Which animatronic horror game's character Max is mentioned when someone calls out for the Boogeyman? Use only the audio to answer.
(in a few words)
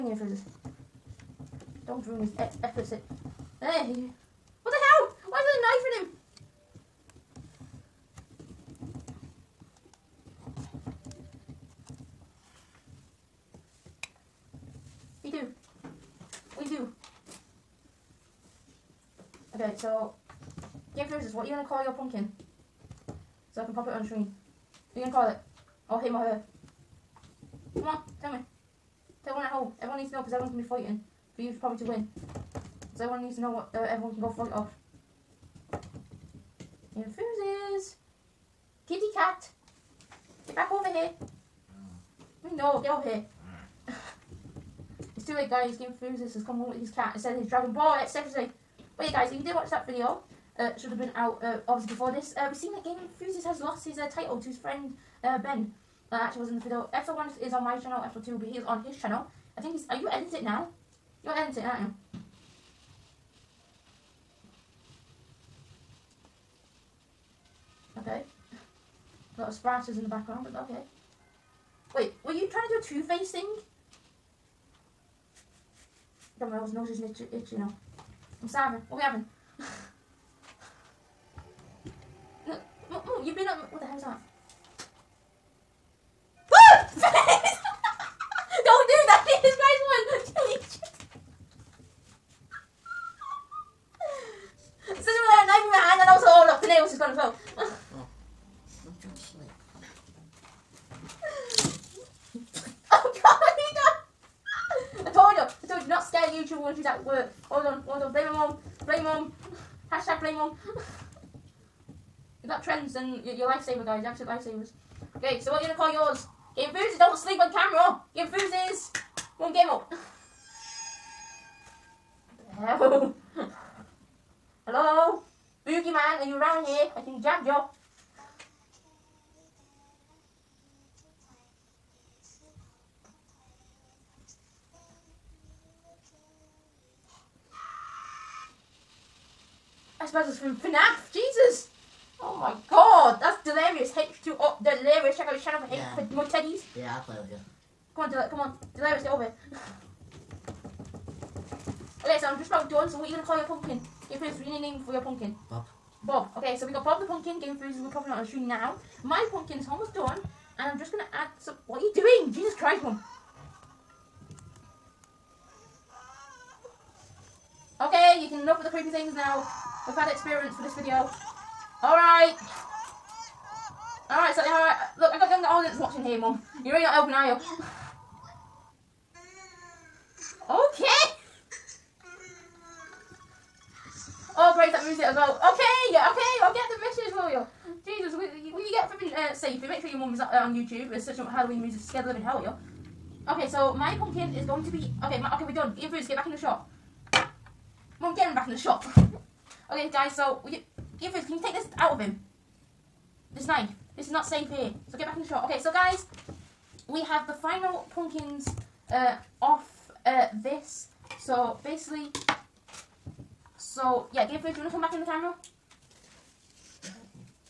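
FNAF.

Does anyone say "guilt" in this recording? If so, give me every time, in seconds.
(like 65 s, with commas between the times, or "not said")
not said.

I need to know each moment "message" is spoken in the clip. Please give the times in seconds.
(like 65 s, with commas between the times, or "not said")
186 s.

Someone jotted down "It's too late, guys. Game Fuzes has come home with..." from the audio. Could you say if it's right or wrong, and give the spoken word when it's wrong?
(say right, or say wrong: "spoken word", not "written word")
right.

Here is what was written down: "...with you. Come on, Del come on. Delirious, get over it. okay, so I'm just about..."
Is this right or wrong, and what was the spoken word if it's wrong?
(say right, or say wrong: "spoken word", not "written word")
right.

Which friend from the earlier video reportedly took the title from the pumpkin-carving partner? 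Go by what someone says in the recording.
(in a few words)
Ben.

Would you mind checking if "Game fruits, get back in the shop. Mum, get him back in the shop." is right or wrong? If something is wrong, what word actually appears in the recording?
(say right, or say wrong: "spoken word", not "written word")
right.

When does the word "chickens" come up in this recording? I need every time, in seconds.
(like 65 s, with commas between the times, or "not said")
not said.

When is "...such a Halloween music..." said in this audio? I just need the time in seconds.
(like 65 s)
191 s.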